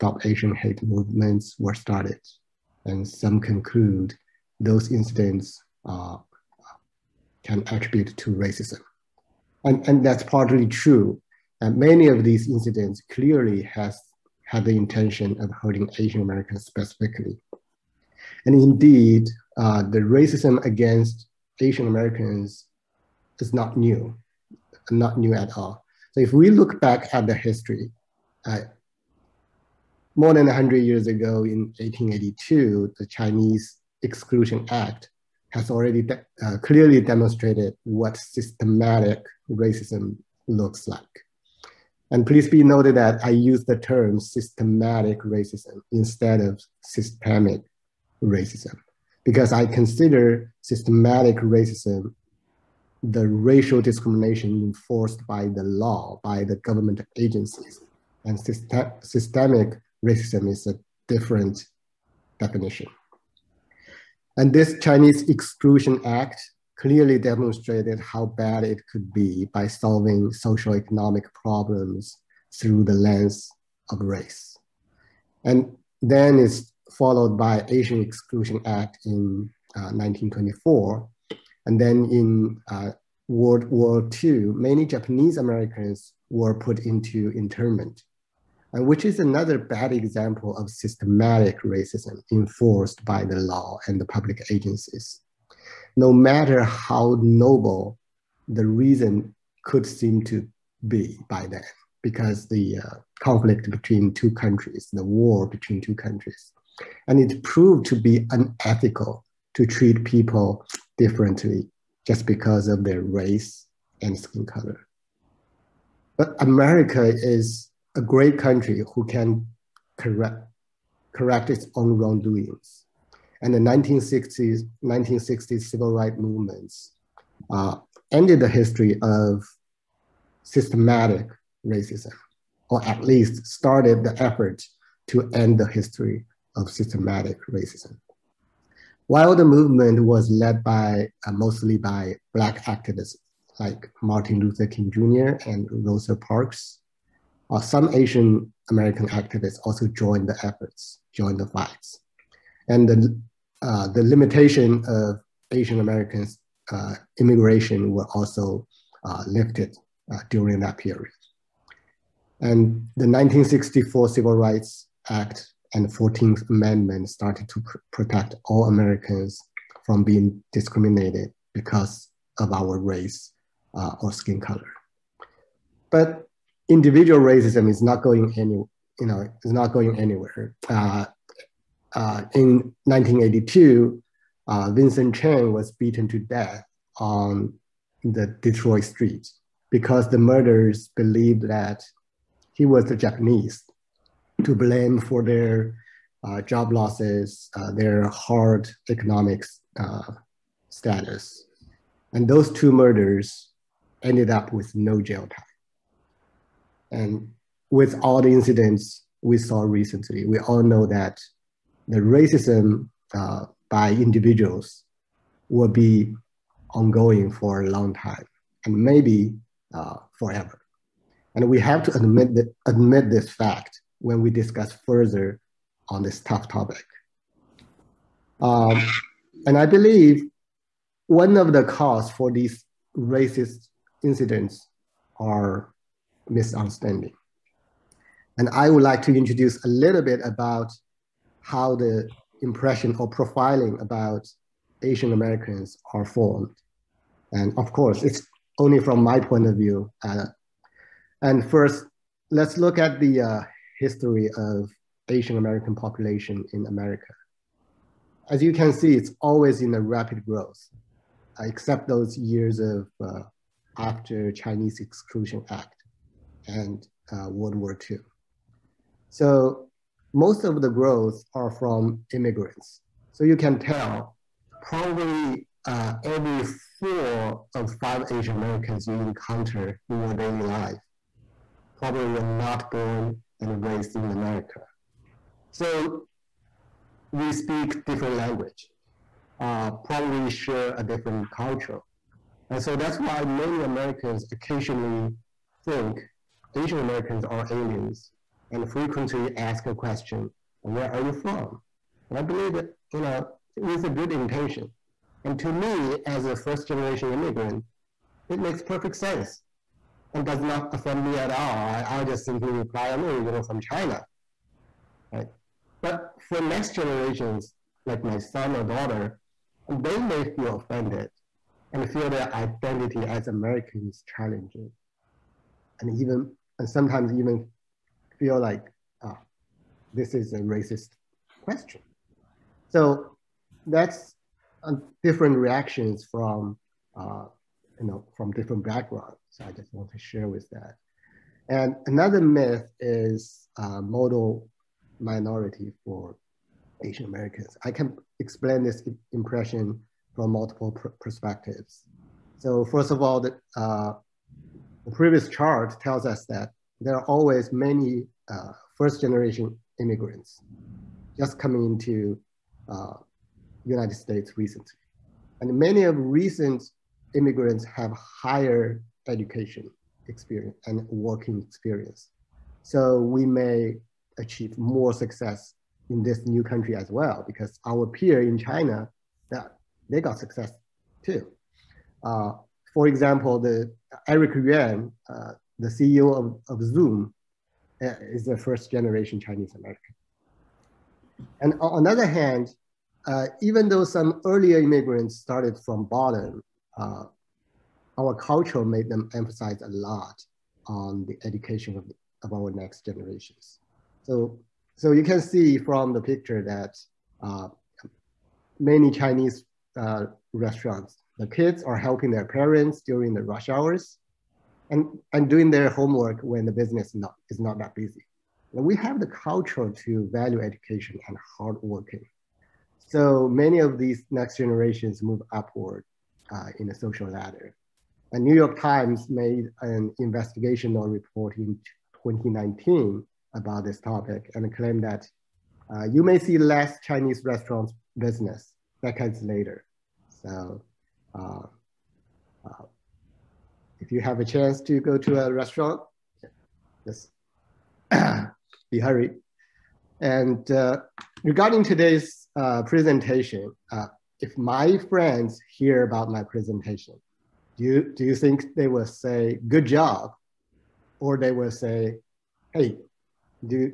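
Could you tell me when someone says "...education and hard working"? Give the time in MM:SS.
07:00.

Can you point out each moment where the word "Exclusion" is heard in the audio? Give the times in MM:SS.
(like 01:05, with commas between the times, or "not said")
00:34, 01:05, 01:18, 04:24.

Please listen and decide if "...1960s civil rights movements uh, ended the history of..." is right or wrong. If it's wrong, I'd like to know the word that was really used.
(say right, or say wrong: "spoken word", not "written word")
right.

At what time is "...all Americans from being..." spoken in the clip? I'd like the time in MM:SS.
02:48.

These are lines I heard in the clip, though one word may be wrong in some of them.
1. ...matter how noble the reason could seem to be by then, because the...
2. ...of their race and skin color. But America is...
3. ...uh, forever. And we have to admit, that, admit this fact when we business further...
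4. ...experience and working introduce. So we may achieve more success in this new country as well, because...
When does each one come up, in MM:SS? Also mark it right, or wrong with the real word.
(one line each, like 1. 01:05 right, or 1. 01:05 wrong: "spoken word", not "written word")
1. 01:36 right
2. 01:52 right
3. 03:39 wrong: "discuss", not "business"
4. 06:10 wrong: "experience", not "introduce".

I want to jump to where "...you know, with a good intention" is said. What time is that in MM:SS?
05:02.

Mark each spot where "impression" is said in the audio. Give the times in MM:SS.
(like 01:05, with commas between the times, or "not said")
04:02, 05:49.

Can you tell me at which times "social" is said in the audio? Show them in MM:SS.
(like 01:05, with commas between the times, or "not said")
01:10, 07:06.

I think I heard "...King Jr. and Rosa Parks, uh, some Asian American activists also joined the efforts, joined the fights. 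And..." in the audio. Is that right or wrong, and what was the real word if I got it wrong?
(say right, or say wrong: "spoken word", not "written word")
right.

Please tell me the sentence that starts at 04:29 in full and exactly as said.
So most of the growth are from immigrants.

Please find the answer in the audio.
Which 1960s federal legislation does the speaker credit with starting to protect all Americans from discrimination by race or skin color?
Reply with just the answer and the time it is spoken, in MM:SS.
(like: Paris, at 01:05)
1964 Civil Rights Act, at 02:43.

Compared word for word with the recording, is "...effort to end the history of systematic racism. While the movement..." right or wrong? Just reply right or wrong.
right.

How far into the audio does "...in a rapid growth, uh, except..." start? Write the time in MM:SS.
04:19.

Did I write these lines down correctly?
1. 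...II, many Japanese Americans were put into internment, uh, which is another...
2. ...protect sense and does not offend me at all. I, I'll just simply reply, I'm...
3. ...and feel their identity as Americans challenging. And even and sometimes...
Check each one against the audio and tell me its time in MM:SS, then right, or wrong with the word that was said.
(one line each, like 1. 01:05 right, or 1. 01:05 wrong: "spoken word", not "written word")
1. 01:24 right
2. 05:08 wrong: "perfect", not "protect"
3. 05:21 right.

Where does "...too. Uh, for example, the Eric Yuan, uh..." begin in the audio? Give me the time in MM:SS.
06:21.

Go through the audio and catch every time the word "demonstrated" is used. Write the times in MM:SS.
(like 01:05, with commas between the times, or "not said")
00:37, 01:07.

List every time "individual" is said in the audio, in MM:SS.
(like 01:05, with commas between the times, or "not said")
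02:56, 03:33.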